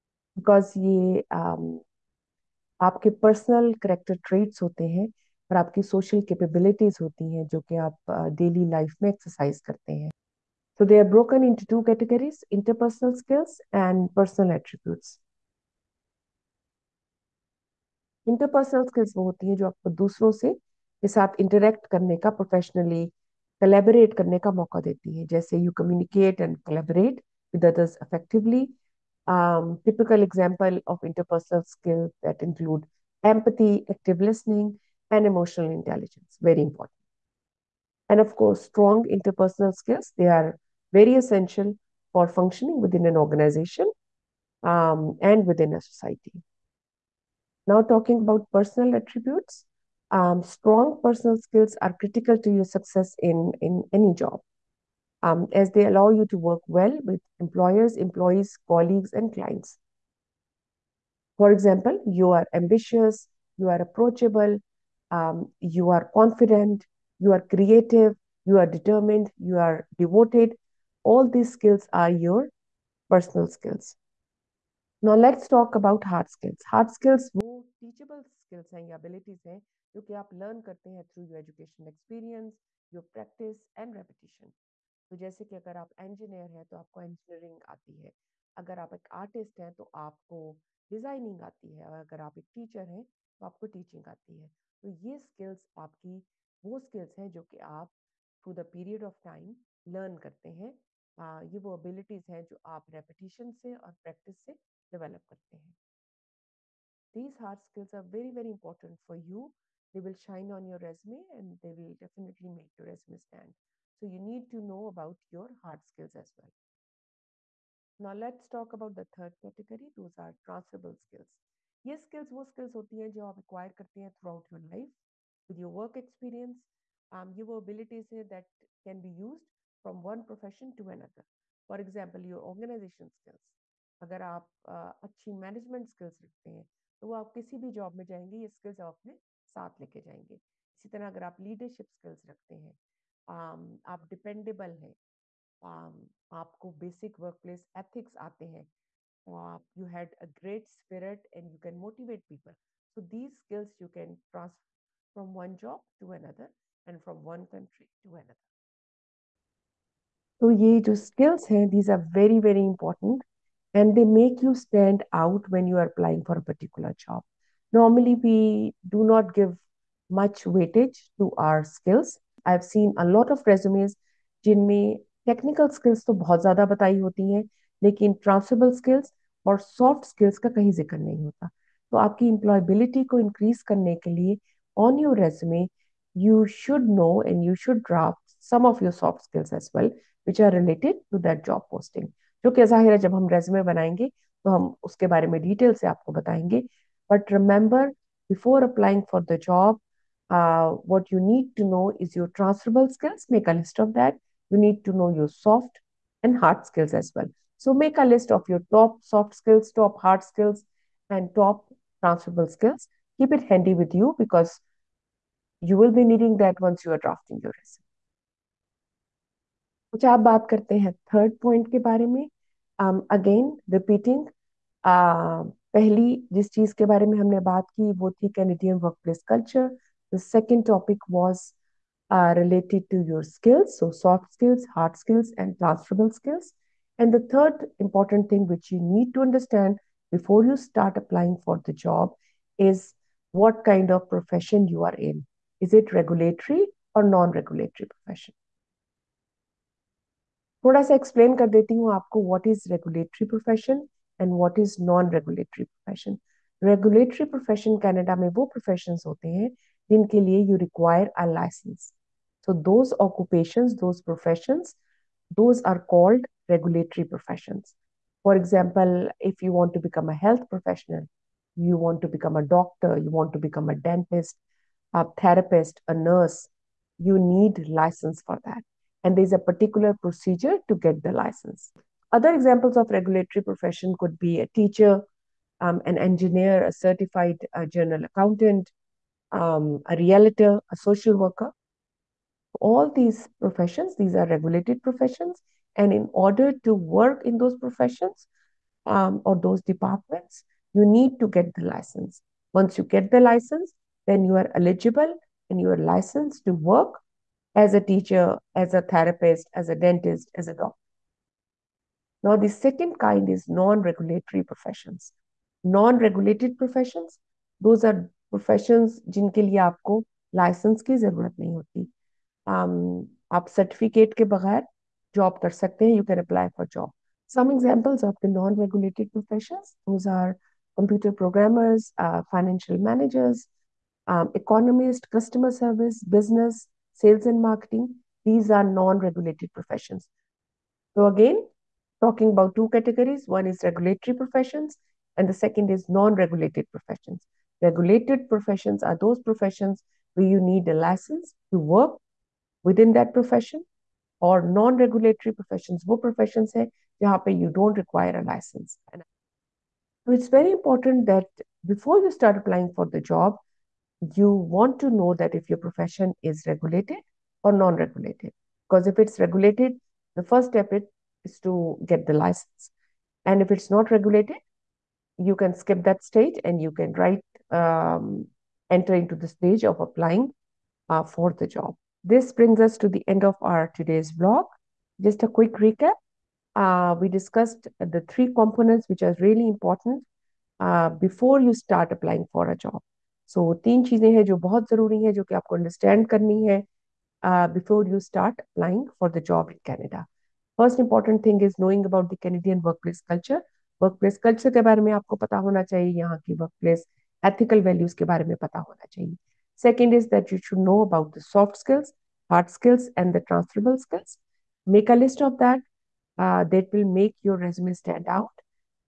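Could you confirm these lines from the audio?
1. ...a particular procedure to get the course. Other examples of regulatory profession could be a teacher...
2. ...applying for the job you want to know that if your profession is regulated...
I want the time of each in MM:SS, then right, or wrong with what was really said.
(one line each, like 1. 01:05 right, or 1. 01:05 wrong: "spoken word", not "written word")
1. 04:39 wrong: "license", not "course"
2. 06:02 right.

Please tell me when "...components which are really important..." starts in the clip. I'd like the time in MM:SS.
06:28.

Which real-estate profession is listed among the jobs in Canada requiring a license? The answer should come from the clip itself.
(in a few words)
realtor.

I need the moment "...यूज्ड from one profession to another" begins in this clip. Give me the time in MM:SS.
02:09.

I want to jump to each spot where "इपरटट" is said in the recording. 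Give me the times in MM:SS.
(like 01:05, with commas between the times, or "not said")
01:48, 02:42, 06:40.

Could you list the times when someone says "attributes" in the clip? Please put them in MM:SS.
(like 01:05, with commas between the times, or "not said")
00:14, 00:48.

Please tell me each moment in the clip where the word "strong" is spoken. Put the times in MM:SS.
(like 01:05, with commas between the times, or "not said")
00:38, 00:50.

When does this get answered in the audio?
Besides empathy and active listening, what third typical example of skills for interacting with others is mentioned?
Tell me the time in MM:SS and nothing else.
00:35.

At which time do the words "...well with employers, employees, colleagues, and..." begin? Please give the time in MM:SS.
00:56.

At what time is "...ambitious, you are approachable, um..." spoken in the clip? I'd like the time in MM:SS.
01:02.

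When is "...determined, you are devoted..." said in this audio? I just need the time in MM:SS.
01:08.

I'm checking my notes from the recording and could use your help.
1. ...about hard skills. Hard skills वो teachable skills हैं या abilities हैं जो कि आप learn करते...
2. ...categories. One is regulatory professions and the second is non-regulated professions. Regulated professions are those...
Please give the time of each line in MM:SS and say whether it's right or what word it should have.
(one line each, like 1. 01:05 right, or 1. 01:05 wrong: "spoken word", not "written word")
1. 01:15 right
2. 05:42 right.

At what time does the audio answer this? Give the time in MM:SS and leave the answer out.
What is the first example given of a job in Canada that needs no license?
05:30.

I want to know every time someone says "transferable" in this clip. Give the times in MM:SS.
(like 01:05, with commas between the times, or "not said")
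03:22, 03:32, 06:53.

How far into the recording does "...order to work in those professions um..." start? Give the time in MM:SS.
04:56.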